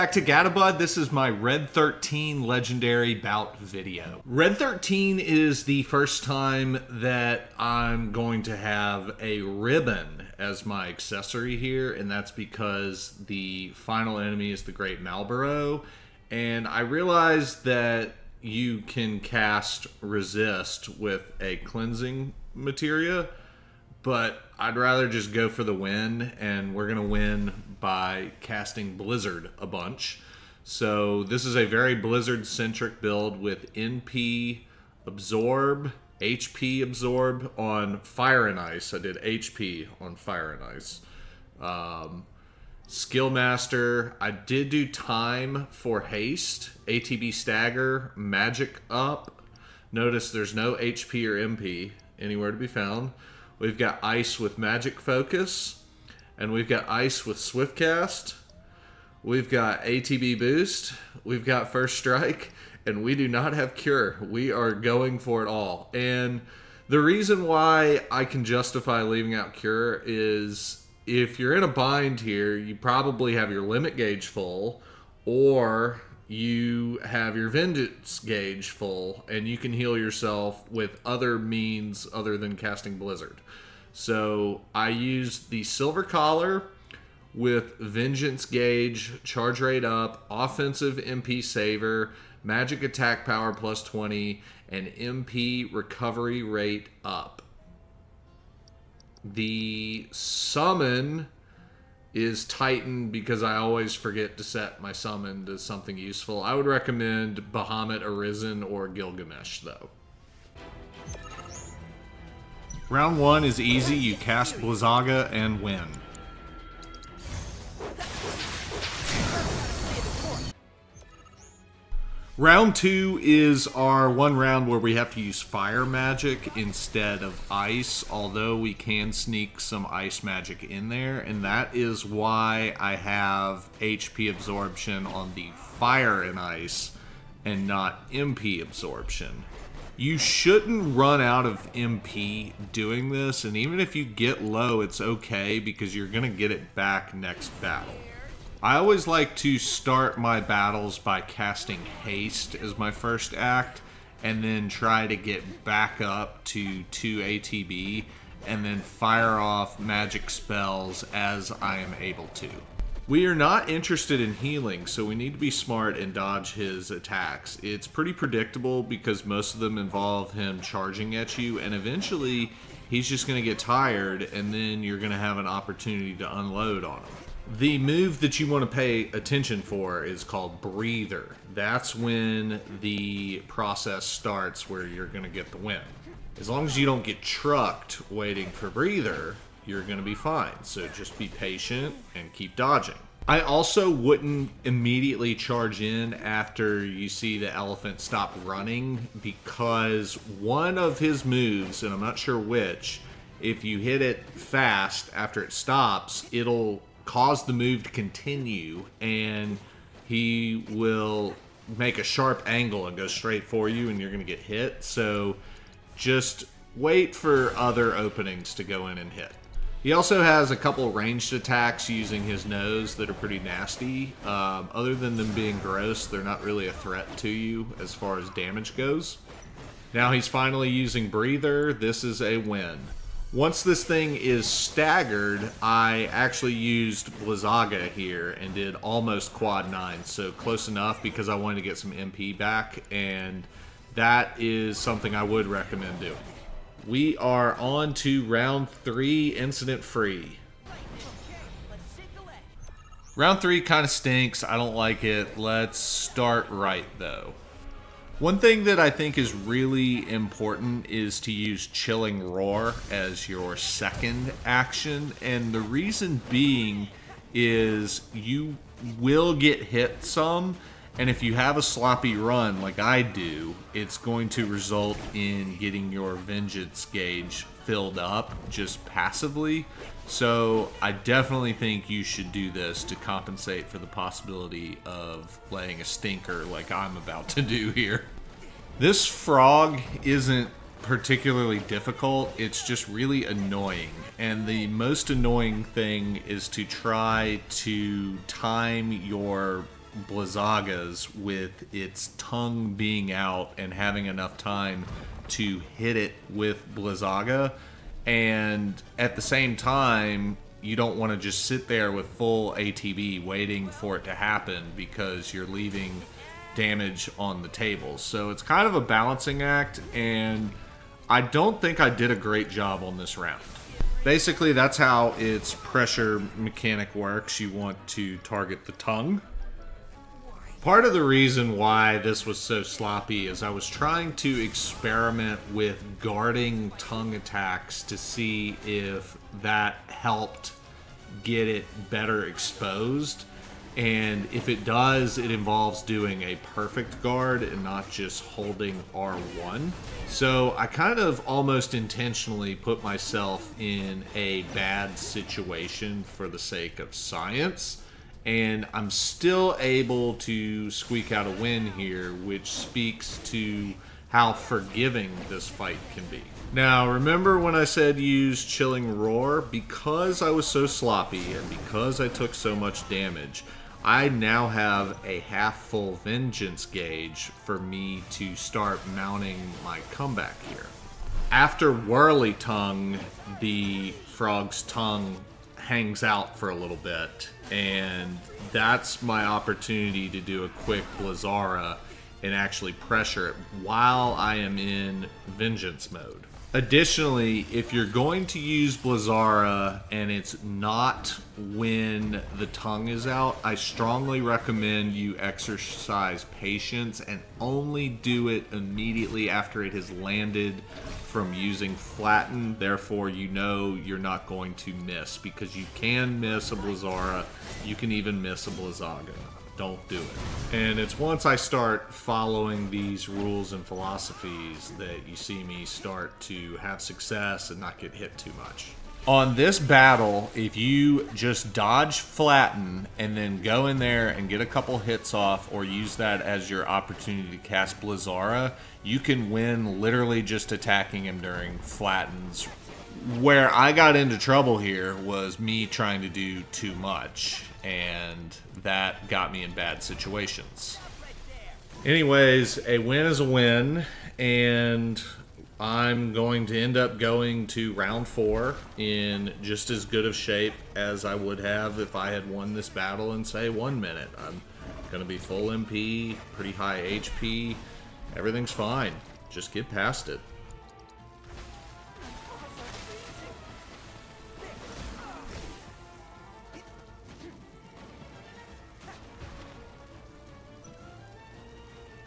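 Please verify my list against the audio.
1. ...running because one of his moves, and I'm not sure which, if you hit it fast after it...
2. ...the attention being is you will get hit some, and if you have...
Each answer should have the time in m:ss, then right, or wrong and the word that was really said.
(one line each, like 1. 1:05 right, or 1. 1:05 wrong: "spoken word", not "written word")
1. 3:18 right
2. 4:25 wrong: "reason", not "attention".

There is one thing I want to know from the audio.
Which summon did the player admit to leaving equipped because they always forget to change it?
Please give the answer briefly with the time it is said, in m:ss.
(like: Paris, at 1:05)
Titan, at 1:42.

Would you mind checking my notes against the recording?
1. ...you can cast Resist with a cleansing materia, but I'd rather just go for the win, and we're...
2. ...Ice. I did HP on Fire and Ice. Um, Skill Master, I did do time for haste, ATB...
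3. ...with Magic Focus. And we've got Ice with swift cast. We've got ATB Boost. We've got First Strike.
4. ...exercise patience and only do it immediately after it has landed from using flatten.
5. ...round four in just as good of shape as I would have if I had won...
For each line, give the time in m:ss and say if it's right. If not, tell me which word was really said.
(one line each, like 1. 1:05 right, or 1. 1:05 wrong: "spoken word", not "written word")
1. 0:18 right
2. 0:38 right
3. 0:54 right
4. 6:45 right
5. 7:37 right.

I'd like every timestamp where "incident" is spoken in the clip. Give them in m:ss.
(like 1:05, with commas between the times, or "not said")
4:09.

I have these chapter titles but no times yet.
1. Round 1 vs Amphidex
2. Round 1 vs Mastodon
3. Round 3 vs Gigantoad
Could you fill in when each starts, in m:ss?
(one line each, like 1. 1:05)
1. 1:50
2. 2:00
3. 4:12.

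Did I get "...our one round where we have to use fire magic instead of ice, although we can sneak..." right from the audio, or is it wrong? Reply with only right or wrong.
right.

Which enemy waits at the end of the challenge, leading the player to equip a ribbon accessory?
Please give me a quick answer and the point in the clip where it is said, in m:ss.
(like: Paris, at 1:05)
Great Malboro, at 0:14.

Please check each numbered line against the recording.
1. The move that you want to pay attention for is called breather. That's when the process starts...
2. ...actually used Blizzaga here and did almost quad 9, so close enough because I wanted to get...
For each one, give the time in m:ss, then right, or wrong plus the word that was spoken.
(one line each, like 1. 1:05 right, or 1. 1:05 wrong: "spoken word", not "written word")
1. 2:57 right
2. 3:56 right.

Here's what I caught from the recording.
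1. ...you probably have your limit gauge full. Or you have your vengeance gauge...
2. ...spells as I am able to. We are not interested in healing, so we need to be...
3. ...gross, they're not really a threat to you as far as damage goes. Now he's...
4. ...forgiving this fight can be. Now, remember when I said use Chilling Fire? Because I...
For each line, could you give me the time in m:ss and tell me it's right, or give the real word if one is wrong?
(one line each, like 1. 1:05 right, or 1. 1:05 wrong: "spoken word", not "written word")
1. 1:12 right
2. 2:40 right
3. 3:45 right
4. 6:04 wrong: "Roar", not "Fire".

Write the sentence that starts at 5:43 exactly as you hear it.
And if it does, it involves doing a perfect guard and not just holding R1.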